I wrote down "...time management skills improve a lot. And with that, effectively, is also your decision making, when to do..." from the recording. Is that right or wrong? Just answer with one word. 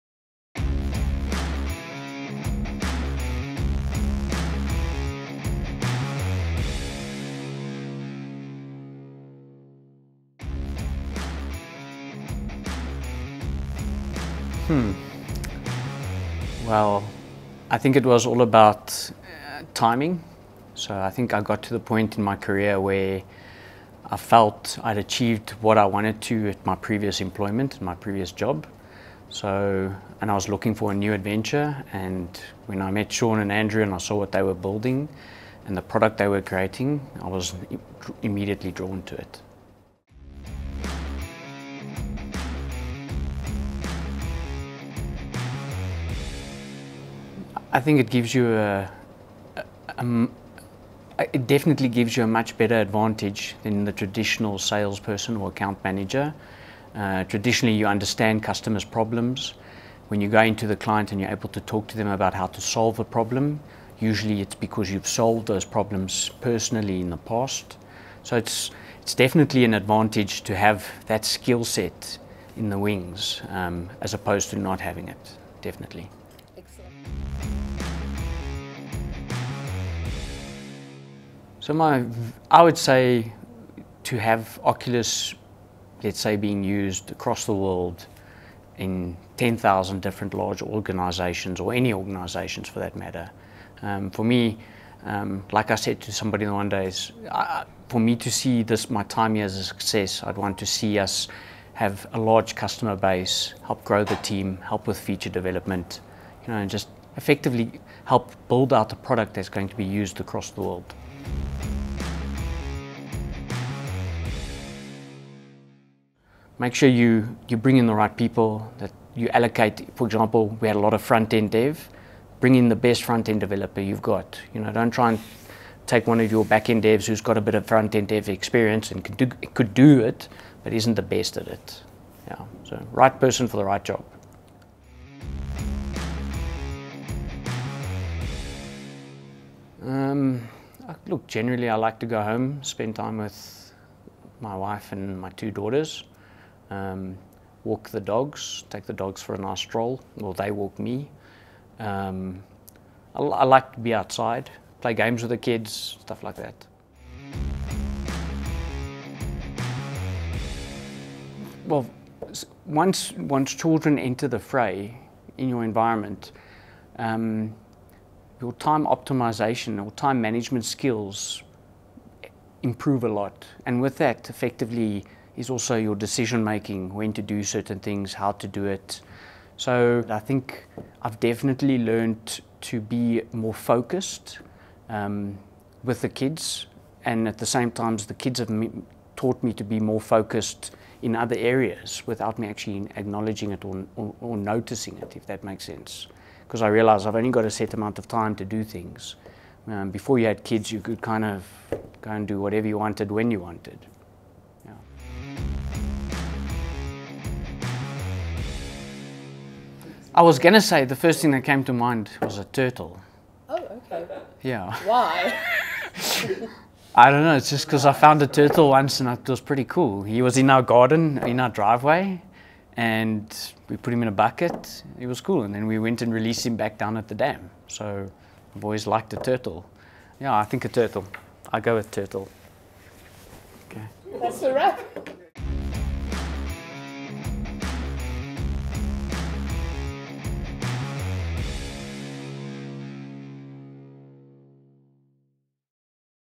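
right.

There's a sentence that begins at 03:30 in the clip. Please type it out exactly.
I was going to say the first thing that came to mind was a turtle.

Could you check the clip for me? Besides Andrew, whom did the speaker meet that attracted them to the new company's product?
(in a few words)
Sean.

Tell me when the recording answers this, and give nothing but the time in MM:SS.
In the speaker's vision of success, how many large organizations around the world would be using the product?
01:29.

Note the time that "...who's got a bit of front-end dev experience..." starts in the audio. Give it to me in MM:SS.
02:07.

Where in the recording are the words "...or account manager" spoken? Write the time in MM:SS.
00:55.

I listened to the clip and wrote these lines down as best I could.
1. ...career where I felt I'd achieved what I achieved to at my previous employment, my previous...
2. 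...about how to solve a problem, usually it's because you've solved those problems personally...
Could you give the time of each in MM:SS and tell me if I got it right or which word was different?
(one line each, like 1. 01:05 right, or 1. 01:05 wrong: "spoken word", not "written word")
1. 00:22 wrong: "wanted", not "achieved"
2. 01:02 right.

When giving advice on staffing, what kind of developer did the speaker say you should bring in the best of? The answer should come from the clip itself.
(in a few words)
Front-end developer.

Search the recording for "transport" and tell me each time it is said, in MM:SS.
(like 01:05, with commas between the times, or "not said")
not said.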